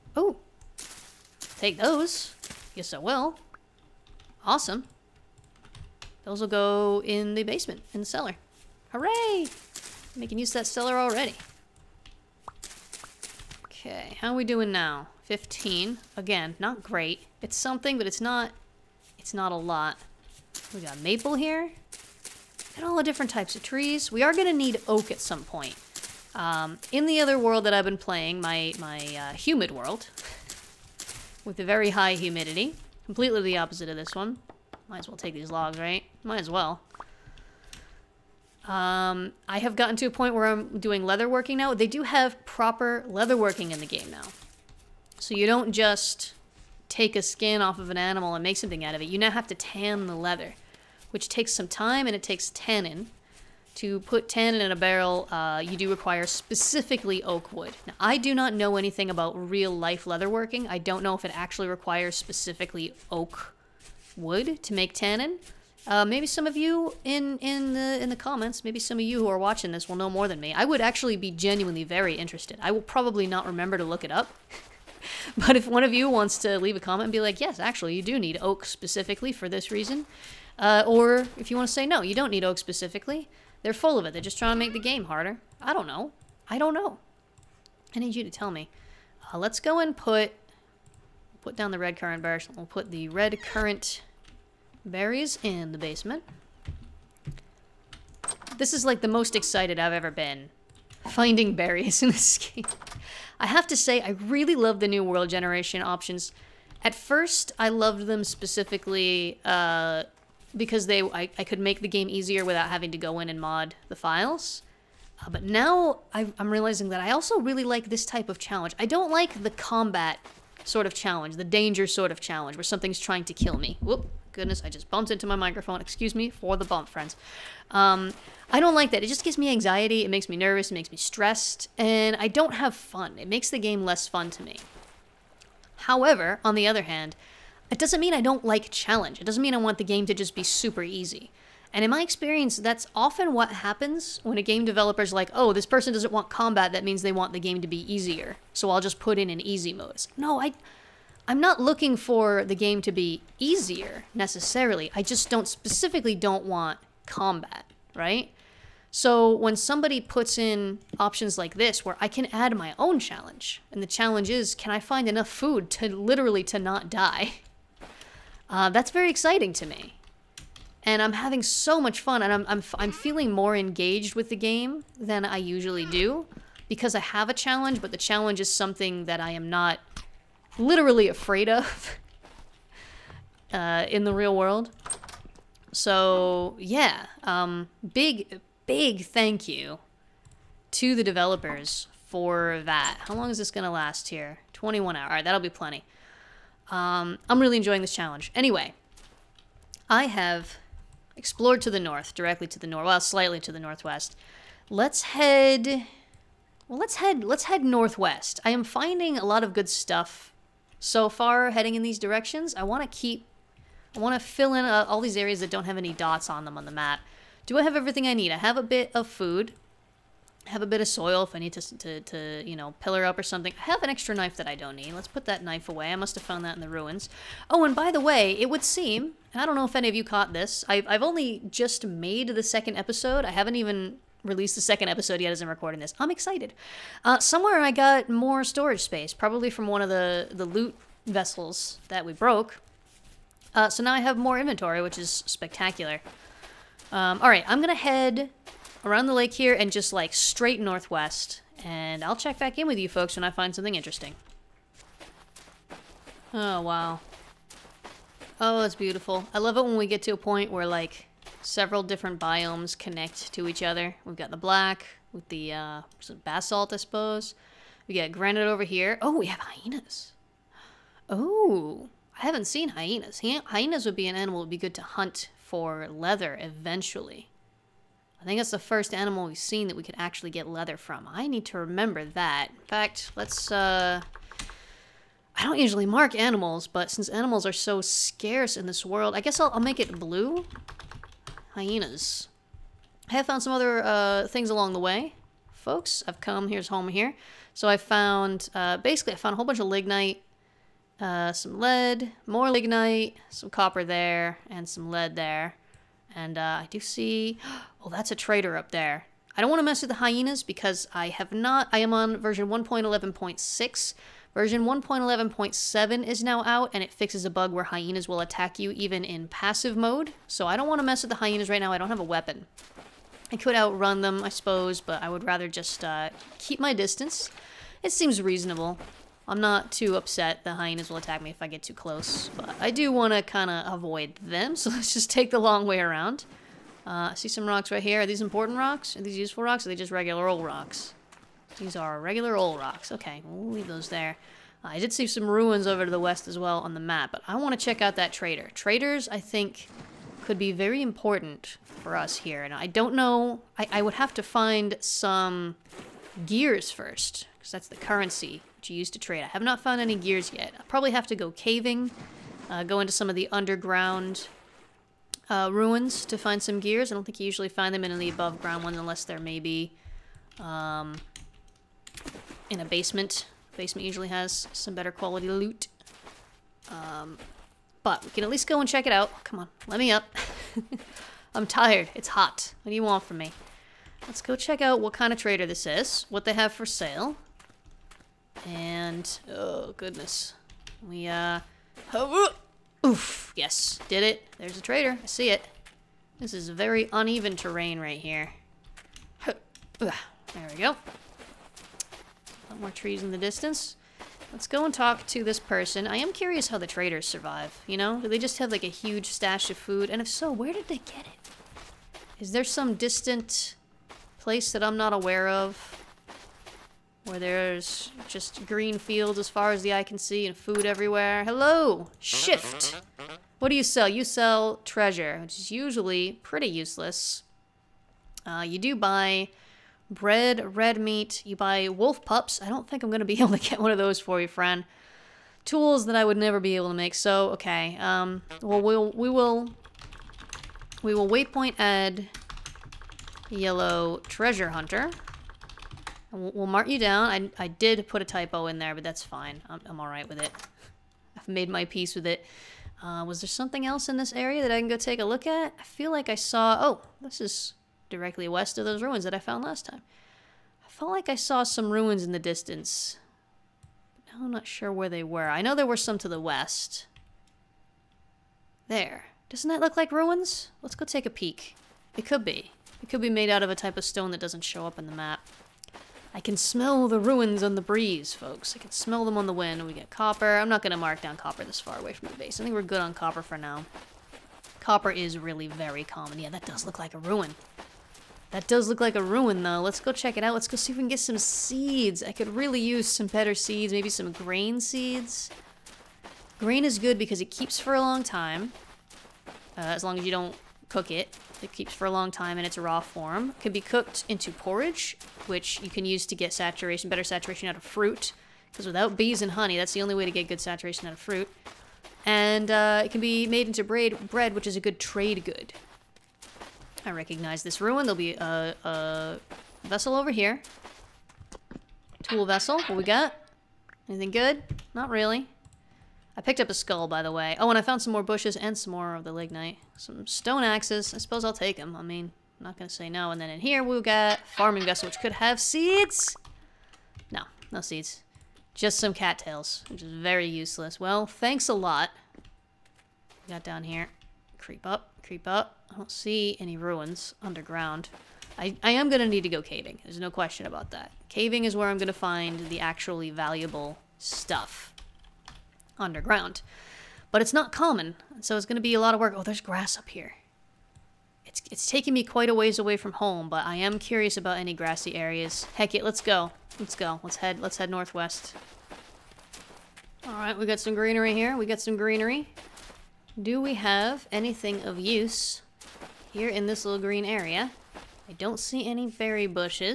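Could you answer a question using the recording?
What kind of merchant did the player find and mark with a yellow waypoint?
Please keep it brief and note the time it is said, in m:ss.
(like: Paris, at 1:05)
treasure hunter, at 7:24.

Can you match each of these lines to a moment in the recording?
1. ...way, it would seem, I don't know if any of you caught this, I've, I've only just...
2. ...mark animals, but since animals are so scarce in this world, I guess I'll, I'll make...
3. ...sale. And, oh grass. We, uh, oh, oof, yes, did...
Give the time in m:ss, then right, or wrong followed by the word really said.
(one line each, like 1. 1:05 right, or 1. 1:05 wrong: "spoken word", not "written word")
1. 3:48 right
2. 4:45 right
3. 6:26 wrong: "goodness", not "grass".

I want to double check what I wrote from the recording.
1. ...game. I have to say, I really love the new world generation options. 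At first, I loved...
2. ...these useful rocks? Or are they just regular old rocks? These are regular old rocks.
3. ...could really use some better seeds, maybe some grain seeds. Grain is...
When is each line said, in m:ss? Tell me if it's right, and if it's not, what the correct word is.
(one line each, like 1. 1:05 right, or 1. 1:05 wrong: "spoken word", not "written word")
1. 1:42 right
2. 5:39 right
3. 8:12 right.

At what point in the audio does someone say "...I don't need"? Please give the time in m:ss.
3:44.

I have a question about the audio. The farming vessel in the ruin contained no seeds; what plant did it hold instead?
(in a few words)
cattails.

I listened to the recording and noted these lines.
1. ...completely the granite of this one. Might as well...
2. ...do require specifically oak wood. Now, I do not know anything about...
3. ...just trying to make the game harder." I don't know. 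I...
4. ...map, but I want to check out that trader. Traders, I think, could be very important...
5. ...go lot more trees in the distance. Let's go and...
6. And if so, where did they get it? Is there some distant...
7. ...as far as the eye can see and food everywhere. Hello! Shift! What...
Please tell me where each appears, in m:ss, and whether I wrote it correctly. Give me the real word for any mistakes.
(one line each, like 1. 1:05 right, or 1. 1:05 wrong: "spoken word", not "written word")
1. 0:33 wrong: "opposite", not "granite"
2. 0:55 right
3. 1:24 right
4. 5:46 right
5. 6:40 right
6. 6:49 right
7. 6:59 right.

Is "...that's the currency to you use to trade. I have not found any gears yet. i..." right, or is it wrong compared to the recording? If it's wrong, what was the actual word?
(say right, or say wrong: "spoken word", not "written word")
right.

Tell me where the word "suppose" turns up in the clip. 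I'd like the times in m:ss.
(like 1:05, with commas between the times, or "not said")
4:26, 5:24, 8:50.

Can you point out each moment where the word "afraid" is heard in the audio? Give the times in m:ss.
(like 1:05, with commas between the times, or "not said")
3:01.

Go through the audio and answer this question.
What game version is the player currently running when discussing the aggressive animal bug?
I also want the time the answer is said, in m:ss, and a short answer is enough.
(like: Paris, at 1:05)
1.11.6, at 5:12.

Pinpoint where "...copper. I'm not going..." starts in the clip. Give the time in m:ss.
7:59.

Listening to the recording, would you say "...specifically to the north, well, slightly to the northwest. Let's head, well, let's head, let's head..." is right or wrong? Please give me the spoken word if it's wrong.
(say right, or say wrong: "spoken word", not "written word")
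wrong: "directly", not "specifically".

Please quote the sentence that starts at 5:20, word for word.
So I don't want to mess with the hyenas right now.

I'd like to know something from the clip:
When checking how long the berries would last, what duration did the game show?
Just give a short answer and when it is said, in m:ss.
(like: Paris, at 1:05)
21 hours, at 3:14.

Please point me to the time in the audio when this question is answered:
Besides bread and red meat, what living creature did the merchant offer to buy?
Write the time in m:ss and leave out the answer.
7:11.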